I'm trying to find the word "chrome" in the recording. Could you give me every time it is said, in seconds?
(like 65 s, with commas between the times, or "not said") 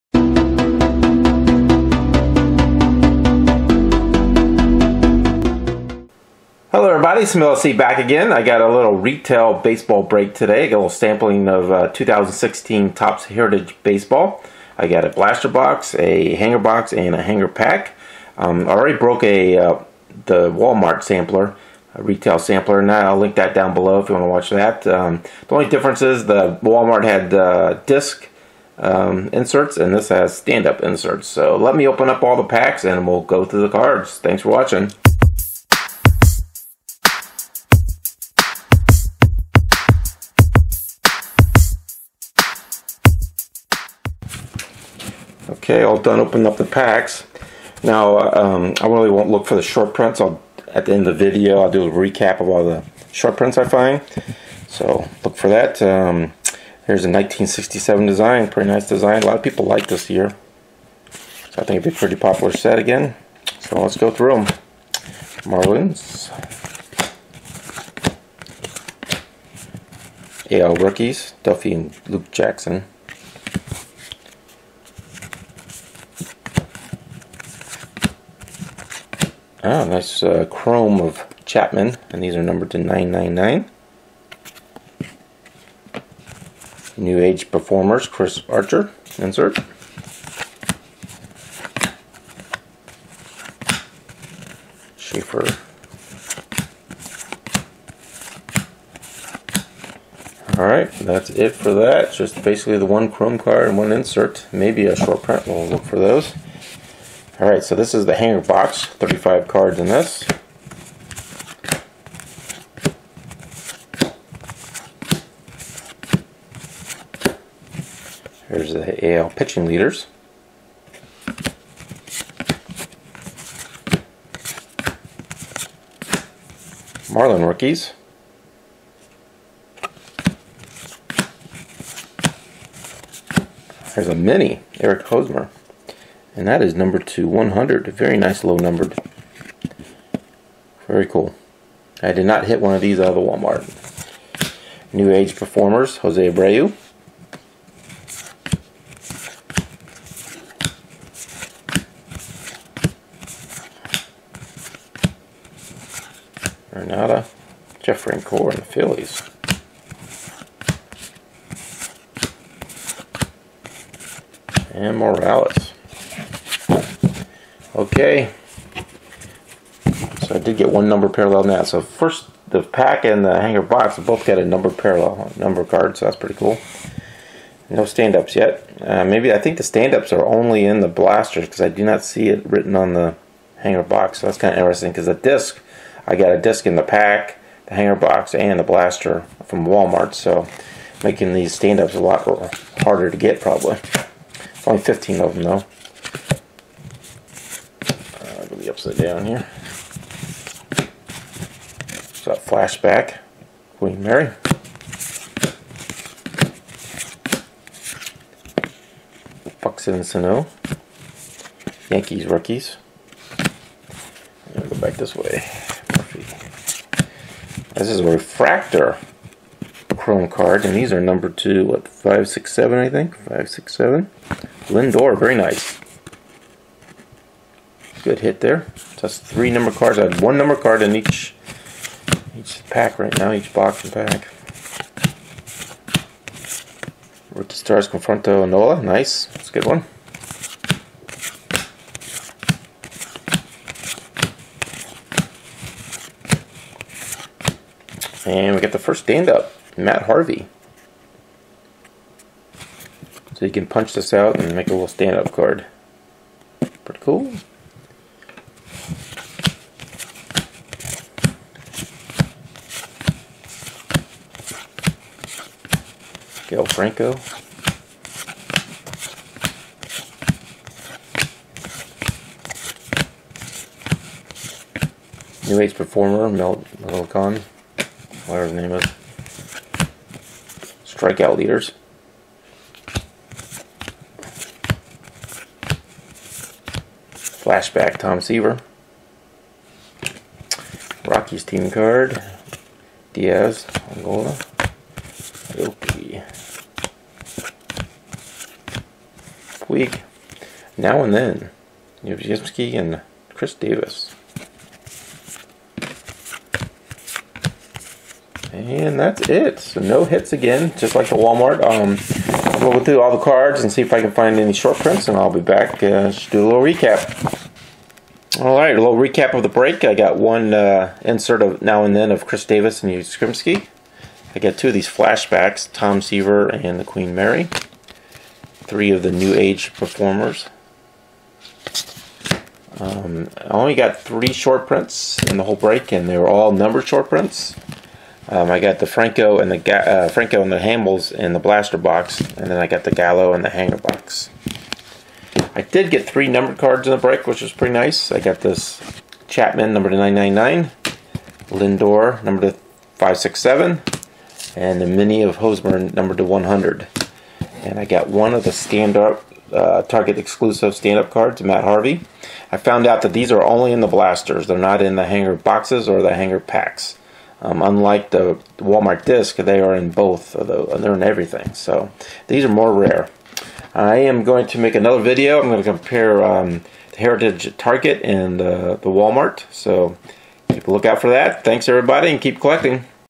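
80 s, 103 s, 219 s.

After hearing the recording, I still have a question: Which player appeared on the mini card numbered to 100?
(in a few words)
Eric Hosmer.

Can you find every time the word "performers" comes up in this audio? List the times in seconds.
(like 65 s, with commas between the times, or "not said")
87 s, 145 s, 275 s, 329 s.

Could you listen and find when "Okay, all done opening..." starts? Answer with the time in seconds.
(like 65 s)
45 s.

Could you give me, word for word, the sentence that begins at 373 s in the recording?
I am going to make another video.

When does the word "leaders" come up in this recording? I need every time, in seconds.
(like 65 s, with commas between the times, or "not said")
119 s, 281 s.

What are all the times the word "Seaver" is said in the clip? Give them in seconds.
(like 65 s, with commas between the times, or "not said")
288 s, 326 s.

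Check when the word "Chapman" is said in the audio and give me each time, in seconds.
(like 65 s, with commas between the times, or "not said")
81 s, 349 s.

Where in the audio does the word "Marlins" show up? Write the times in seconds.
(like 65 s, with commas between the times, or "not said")
65 s, 127 s.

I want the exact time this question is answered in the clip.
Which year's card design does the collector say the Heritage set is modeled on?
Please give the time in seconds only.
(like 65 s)
57 s.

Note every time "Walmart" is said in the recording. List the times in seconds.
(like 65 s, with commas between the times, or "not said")
20 s, 26 s, 143 s, 189 s, 311 s, 368 s, 378 s.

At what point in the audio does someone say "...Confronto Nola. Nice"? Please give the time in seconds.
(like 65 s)
237 s.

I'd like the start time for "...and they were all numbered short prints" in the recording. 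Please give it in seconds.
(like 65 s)
335 s.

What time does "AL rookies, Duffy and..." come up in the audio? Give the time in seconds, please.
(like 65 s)
70 s.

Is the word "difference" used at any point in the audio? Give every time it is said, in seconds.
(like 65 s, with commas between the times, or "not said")
25 s.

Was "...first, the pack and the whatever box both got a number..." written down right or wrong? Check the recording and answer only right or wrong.
wrong.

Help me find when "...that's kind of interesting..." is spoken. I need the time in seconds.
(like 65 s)
184 s.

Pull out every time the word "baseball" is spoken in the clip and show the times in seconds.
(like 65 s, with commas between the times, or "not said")
9 s, 13 s.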